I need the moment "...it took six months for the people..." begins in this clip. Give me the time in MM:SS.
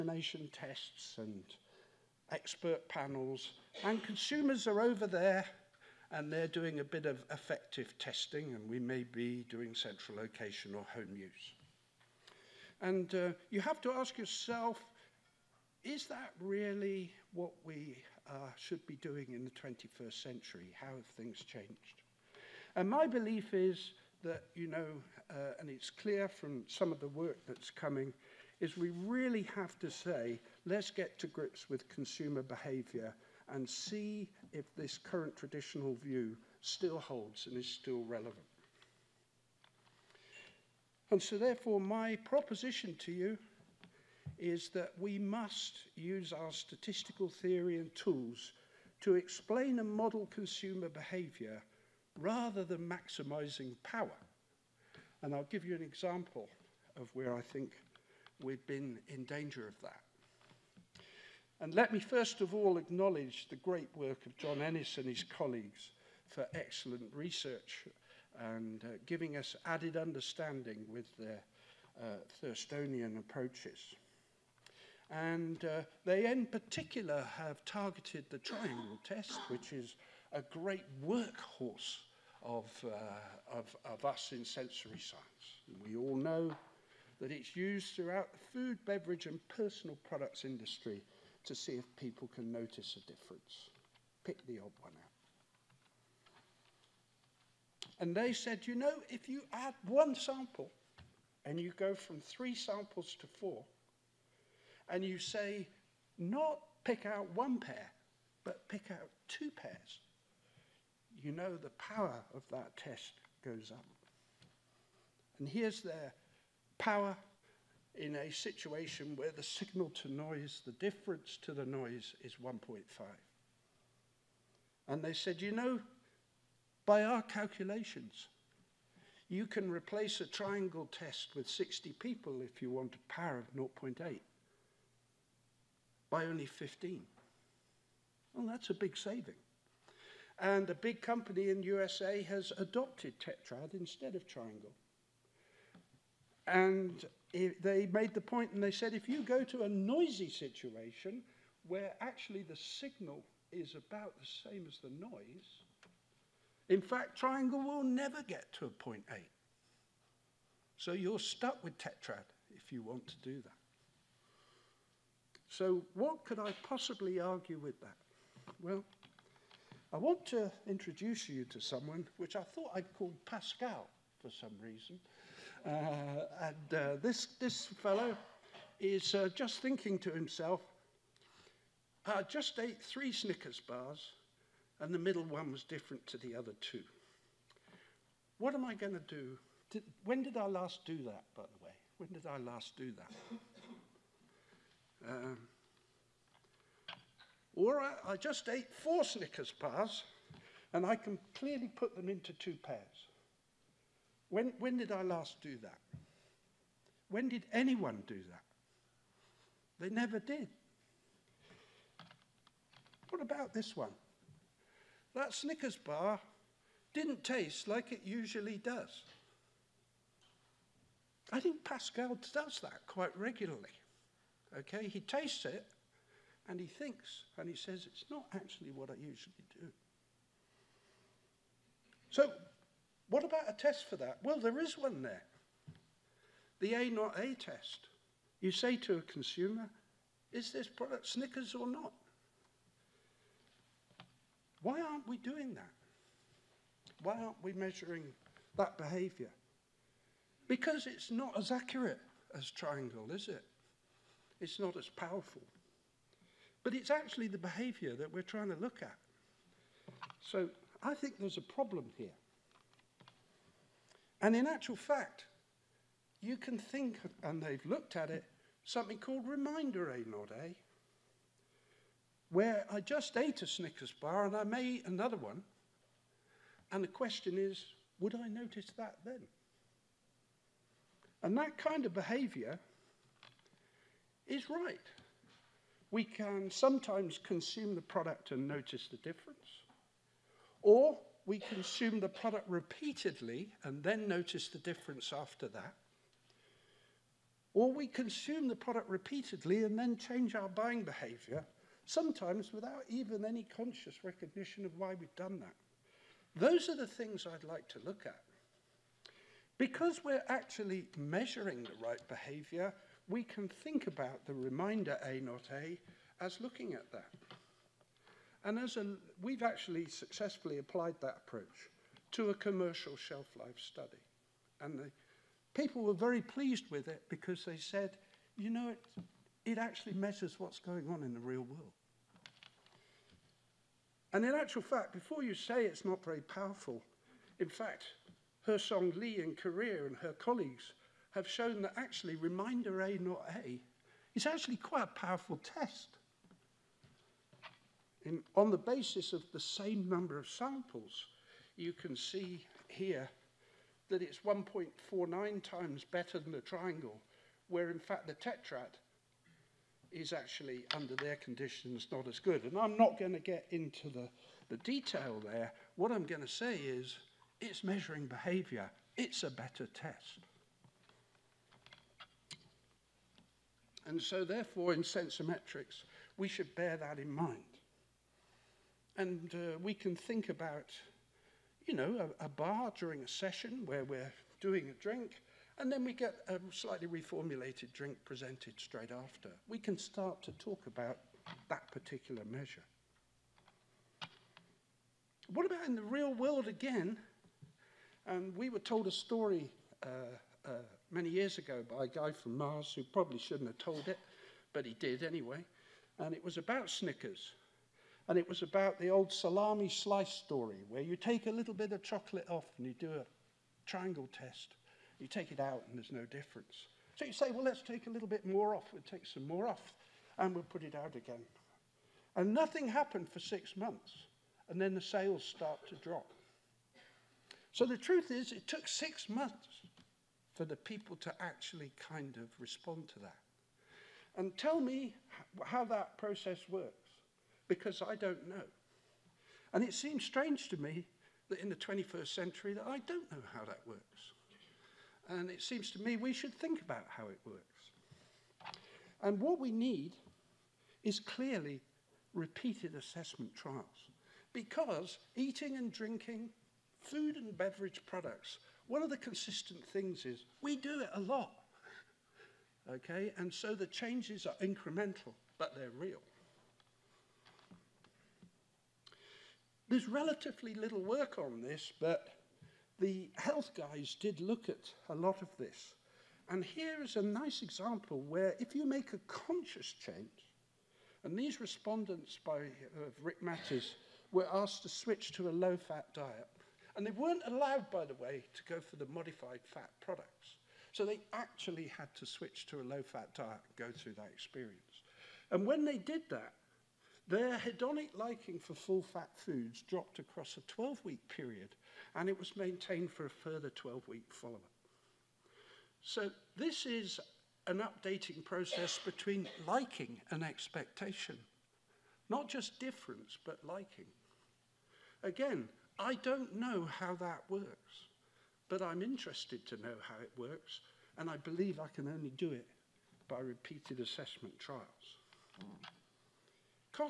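07:08.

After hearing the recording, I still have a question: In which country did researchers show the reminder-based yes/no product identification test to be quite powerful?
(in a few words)
Korea.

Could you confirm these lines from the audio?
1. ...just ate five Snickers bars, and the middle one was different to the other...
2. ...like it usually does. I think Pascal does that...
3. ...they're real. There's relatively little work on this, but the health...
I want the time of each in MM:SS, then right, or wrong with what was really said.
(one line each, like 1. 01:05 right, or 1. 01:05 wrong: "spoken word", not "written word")
1. 03:02 wrong: "three", not "five"
2. 03:37 right
3. 07:45 right.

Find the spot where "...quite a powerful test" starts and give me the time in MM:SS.
05:44.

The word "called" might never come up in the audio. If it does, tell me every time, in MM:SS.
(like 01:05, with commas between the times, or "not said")
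02:52, 04:28.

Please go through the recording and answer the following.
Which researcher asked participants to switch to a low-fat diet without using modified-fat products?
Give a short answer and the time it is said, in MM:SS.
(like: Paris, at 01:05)
Rick Mattes, at 08:03.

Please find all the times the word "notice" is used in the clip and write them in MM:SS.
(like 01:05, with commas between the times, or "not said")
01:32, 04:38, 04:48, 04:54.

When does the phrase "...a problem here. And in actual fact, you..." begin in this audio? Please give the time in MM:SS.
04:21.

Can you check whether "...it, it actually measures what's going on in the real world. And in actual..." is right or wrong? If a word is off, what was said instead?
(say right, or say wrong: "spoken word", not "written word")
right.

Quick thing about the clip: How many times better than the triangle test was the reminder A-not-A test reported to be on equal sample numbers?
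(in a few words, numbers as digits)
1.49.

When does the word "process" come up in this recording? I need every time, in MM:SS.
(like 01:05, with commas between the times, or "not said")
07:15, 08:28.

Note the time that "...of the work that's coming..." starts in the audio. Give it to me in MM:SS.
00:26.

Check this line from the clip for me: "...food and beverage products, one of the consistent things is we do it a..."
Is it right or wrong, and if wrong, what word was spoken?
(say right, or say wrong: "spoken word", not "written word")
right.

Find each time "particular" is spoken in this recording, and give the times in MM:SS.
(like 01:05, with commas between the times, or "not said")
01:16, 06:31.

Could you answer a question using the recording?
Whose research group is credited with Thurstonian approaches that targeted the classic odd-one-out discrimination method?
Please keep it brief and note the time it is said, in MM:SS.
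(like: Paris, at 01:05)
John Ennis, at 01:04.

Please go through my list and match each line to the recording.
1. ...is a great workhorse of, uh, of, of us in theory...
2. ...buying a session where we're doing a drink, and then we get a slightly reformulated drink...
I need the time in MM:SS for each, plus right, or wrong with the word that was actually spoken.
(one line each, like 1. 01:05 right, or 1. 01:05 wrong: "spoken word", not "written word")
1. 01:19 wrong: "sensory", not "theory"
2. 06:22 wrong: "during", not "buying".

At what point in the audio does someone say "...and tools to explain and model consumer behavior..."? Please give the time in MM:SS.
00:47.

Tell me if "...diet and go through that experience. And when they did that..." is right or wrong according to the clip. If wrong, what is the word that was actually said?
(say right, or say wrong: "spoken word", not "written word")
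right.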